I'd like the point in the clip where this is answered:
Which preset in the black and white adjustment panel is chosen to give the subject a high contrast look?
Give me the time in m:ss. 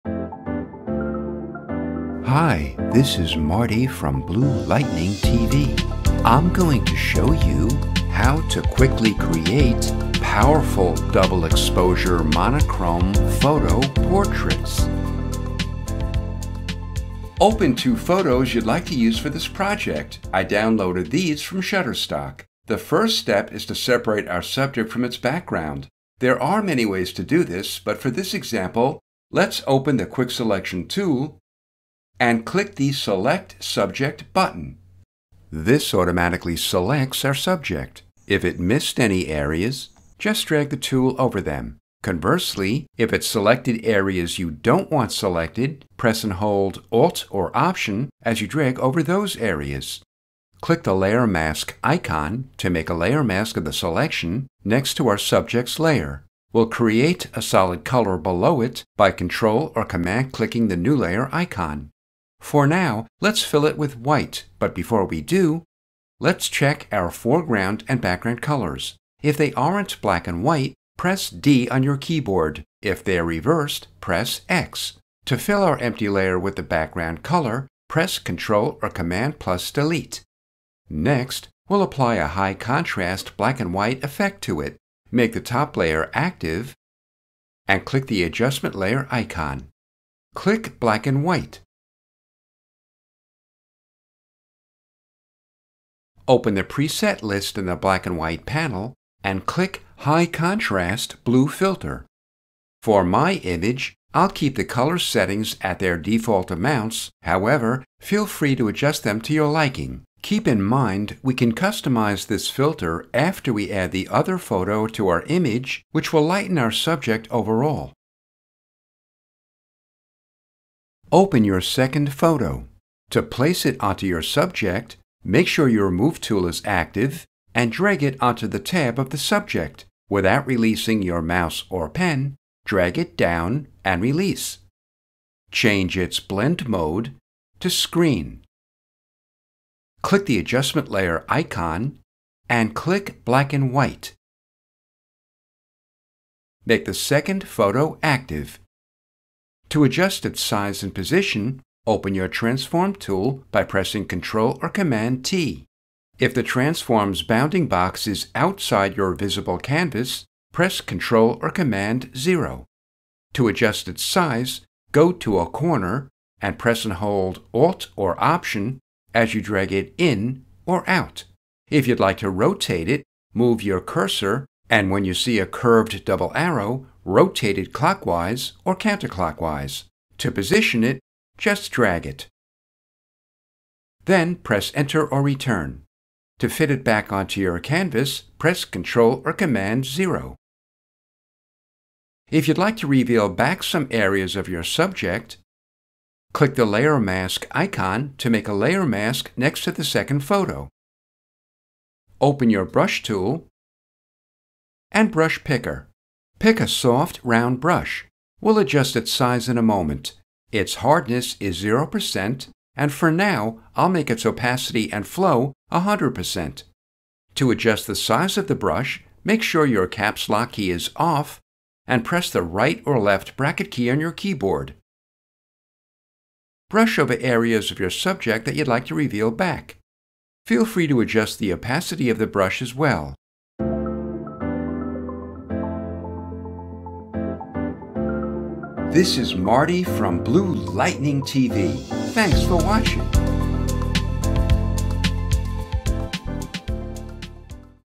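1:40.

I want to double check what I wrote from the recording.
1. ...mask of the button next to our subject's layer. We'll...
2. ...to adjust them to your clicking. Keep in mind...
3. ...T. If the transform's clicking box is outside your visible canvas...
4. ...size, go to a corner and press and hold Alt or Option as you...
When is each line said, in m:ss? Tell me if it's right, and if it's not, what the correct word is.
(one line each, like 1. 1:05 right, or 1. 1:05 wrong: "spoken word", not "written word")
1. 0:53 wrong: "selection", not "button"
2. 1:48 wrong: "liking", not "clicking"
3. 2:35 wrong: "bounding", not "clicking"
4. 2:44 right.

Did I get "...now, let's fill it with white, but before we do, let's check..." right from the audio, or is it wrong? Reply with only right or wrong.
right.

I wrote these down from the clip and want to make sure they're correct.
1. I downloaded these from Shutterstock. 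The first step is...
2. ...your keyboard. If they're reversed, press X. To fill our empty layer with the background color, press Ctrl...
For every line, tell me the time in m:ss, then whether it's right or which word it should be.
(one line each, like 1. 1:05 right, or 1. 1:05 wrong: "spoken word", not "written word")
1. 0:20 right
2. 1:11 right.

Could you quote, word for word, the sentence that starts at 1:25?
Make the top layer active and click the adjustment layer icon.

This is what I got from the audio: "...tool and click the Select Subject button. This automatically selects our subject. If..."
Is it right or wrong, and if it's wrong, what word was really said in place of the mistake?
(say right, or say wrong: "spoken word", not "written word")
right.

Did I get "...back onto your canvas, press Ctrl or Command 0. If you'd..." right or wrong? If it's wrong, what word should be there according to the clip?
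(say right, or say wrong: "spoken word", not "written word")
right.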